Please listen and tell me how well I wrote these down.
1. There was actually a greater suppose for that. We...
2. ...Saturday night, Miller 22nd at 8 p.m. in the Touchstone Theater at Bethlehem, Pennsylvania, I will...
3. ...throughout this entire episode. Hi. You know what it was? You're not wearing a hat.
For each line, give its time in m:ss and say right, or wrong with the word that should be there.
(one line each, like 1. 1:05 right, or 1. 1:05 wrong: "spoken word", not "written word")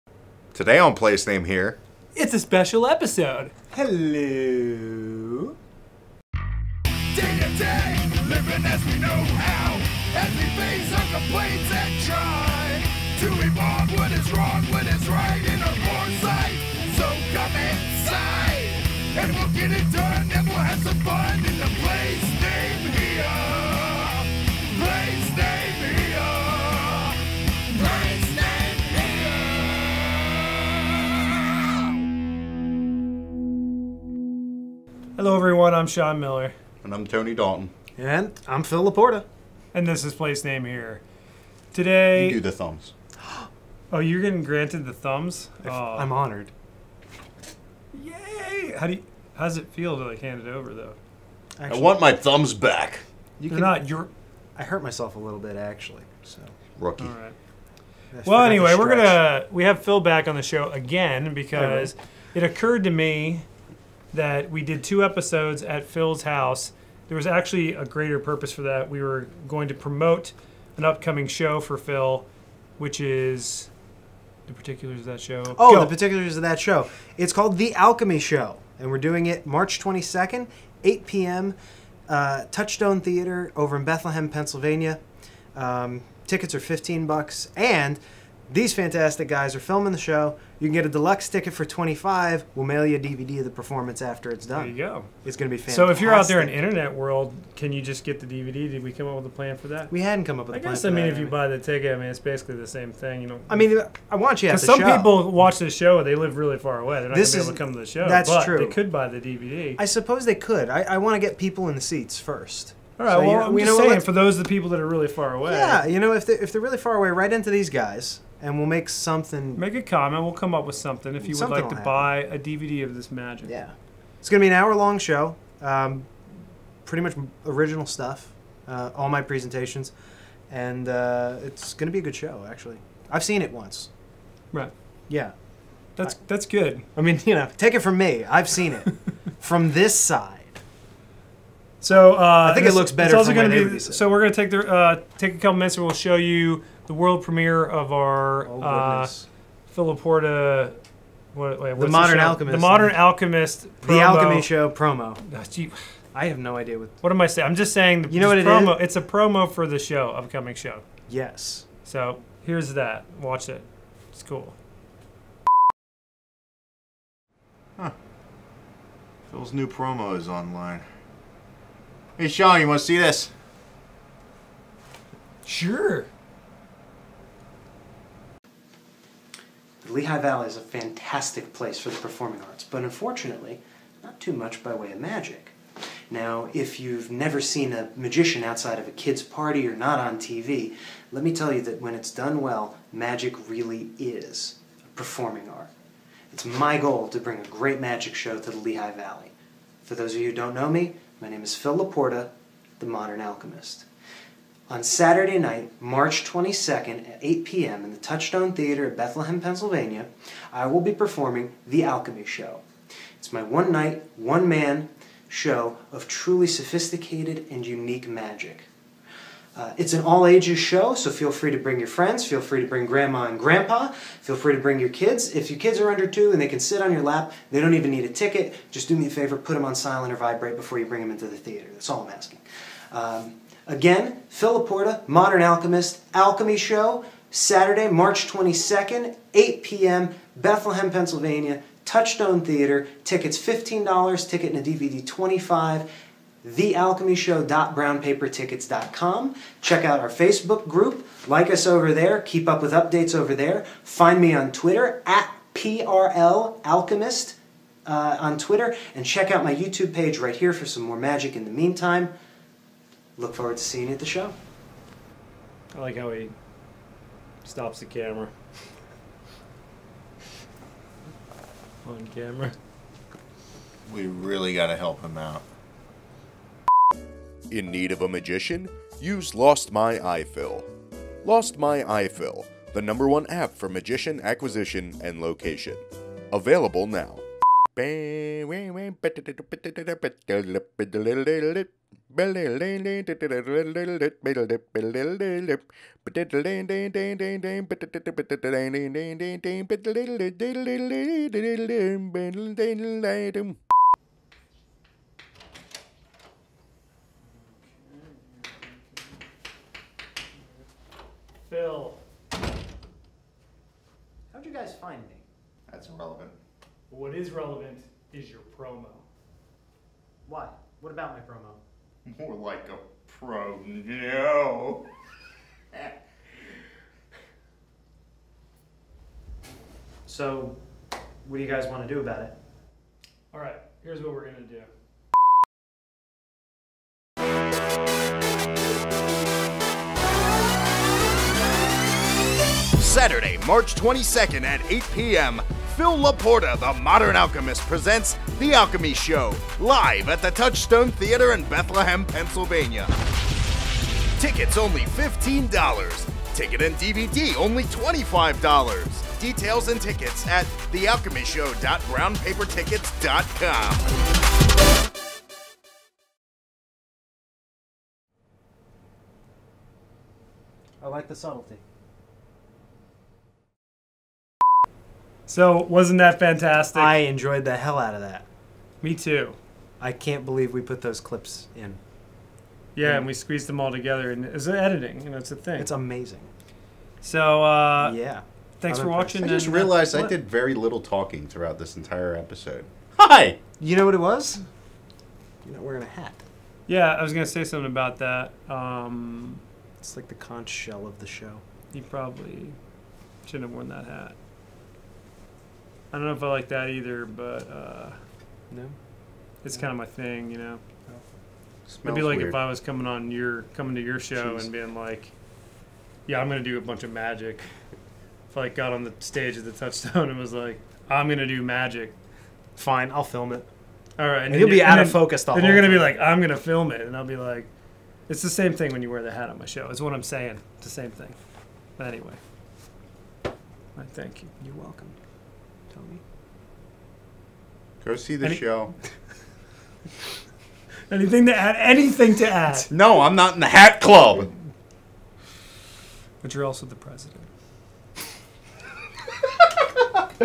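1. 1:07 wrong: "purpose", not "suppose"
2. 3:24 wrong: "March", not "Miller"
3. 6:31 right.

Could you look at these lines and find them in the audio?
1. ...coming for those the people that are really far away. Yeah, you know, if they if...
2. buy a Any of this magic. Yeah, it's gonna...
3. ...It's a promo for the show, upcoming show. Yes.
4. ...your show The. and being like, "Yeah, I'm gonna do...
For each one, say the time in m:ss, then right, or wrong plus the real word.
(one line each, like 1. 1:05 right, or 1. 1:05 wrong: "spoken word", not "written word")
1. 1:53 wrong: "saying", not "coming"
2. 2:01 wrong: "DVD", not "Any"
3. 2:38 right
4. 6:53 wrong: "Jeez", not "The".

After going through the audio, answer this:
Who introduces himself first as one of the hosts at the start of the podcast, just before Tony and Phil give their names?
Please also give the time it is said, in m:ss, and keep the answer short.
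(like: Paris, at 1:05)
Sean Miller, at 0:35.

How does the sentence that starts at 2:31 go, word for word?
What, wait, the Modern the Alchemist.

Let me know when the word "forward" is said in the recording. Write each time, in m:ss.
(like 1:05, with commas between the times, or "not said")
4:23.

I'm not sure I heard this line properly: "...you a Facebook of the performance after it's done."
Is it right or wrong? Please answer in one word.
wrong.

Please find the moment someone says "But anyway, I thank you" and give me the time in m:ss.
7:11.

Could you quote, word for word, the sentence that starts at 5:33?
All right, here's what we're going to do.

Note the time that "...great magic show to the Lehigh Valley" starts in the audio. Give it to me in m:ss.
3:17.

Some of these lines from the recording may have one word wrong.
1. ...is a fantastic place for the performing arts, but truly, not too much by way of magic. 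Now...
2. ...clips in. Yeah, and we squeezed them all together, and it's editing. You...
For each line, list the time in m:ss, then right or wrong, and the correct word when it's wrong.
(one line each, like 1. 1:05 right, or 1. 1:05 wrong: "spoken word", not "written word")
1. 3:00 wrong: "unfortunately", not "truly"
2. 6:20 right.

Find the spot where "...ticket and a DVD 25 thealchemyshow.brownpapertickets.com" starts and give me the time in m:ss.
4:04.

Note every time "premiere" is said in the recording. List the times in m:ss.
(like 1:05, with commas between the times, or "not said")
2:27.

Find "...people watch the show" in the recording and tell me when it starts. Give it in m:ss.
1:44.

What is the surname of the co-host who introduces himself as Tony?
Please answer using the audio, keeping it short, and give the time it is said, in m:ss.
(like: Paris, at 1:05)
Dalton, at 0:37.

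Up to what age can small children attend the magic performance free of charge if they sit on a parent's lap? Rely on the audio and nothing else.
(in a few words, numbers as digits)
Under 2.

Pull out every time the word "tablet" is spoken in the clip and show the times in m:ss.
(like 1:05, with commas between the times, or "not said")
not said.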